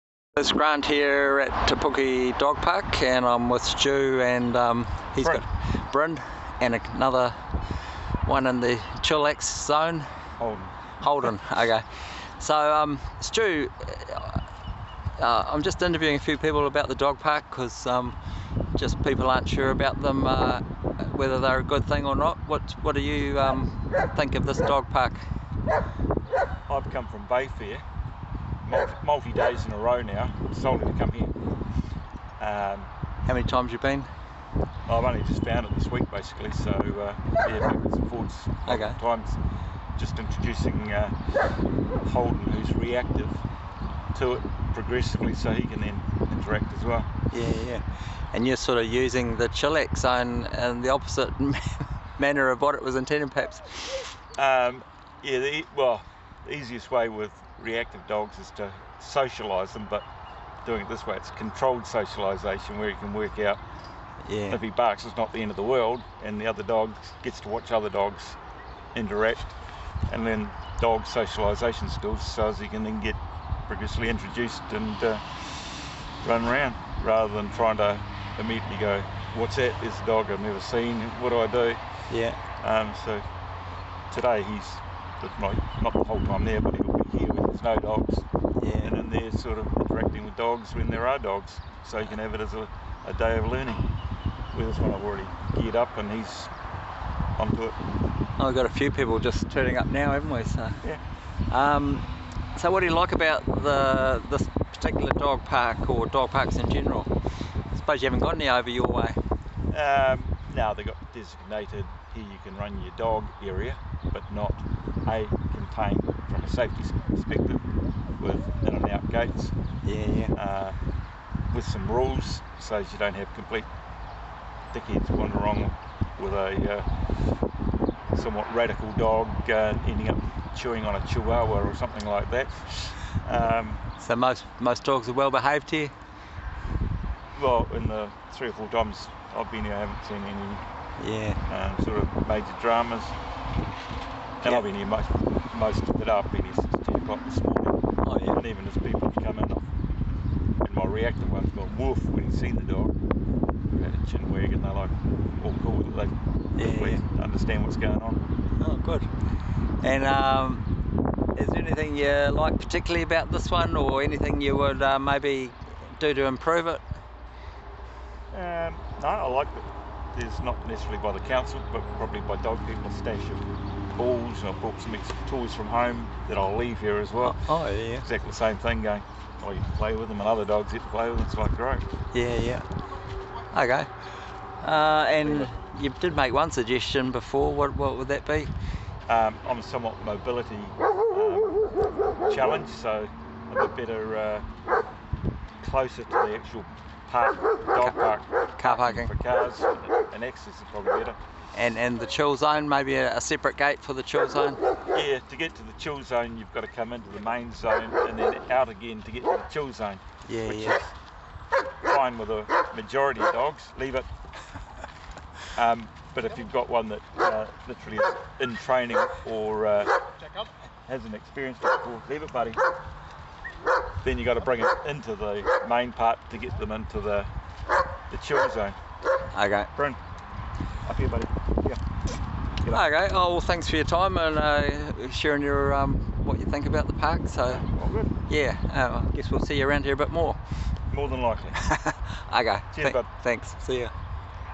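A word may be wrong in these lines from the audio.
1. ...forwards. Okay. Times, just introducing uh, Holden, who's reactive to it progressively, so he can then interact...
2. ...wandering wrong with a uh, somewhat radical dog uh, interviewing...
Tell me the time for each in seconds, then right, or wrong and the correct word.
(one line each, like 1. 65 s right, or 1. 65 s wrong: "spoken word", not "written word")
1. 38 s right
2. 125 s wrong: "ending", not "interviewing".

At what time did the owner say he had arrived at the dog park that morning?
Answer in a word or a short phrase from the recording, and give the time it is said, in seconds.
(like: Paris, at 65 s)
10 o'clock, at 146 s.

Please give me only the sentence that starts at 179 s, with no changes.
you play with them, and other dogs get to play with them, it's like great.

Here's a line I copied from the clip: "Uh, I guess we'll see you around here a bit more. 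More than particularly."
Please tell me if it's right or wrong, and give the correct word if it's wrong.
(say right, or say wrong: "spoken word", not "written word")
wrong: "likely", not "particularly".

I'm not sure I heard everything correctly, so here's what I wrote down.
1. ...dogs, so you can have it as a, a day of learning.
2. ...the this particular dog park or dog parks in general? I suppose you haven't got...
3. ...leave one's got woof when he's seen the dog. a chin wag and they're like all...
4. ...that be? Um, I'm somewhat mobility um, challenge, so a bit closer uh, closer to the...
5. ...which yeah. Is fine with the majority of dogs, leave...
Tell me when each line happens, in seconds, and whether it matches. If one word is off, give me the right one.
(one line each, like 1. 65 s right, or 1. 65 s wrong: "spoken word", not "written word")
1. 91 s right
2. 103 s right
3. 150 s wrong: "reactive", not "leave"
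4. 188 s wrong: "better", not "closer"
5. 210 s right.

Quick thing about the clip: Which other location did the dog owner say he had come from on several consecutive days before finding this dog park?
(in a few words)
Bayfair.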